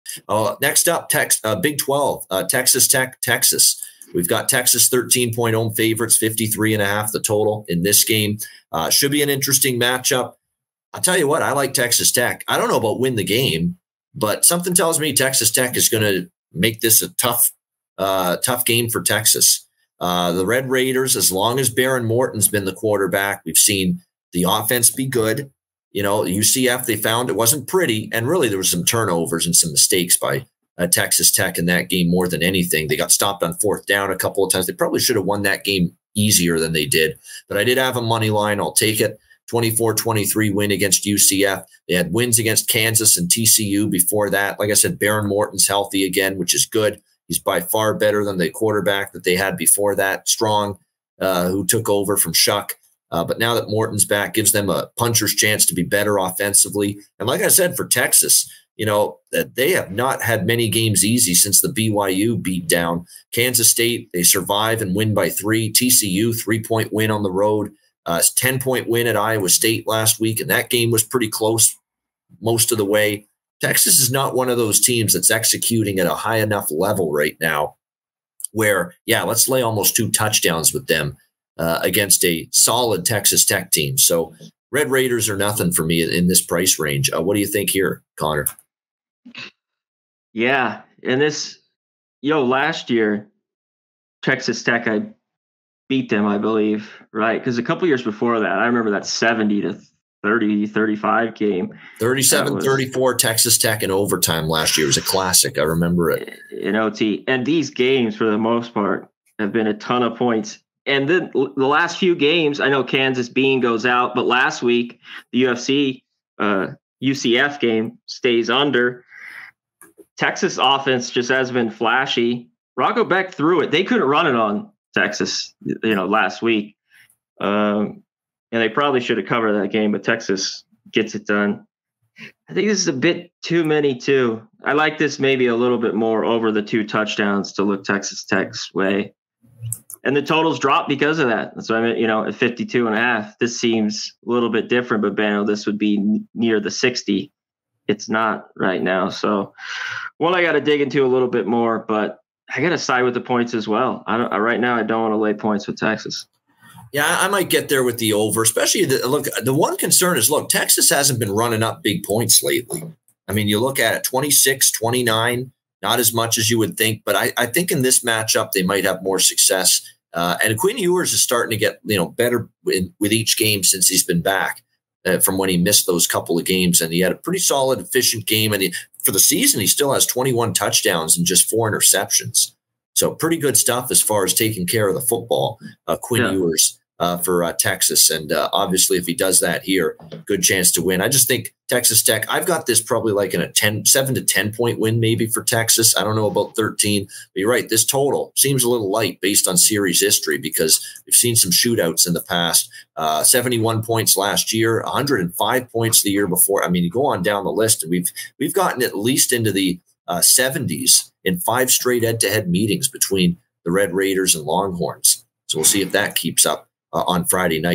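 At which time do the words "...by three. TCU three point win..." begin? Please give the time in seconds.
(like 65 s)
65 s.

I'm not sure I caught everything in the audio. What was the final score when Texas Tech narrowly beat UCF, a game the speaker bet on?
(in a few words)
24-23.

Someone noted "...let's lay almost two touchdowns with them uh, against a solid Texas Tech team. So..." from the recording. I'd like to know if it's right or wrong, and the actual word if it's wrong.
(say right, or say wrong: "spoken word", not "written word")
right.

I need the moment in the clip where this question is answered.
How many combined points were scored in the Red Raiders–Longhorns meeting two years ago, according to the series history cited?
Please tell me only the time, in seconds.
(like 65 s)
204 s.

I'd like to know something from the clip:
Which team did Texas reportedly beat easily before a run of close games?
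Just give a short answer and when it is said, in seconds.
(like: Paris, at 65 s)
BYU, at 61 s.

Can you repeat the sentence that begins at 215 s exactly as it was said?
So we'll see if that keeps up uh, on Friday night.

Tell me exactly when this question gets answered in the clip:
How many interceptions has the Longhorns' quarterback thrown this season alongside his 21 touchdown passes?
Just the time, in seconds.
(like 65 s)
181 s.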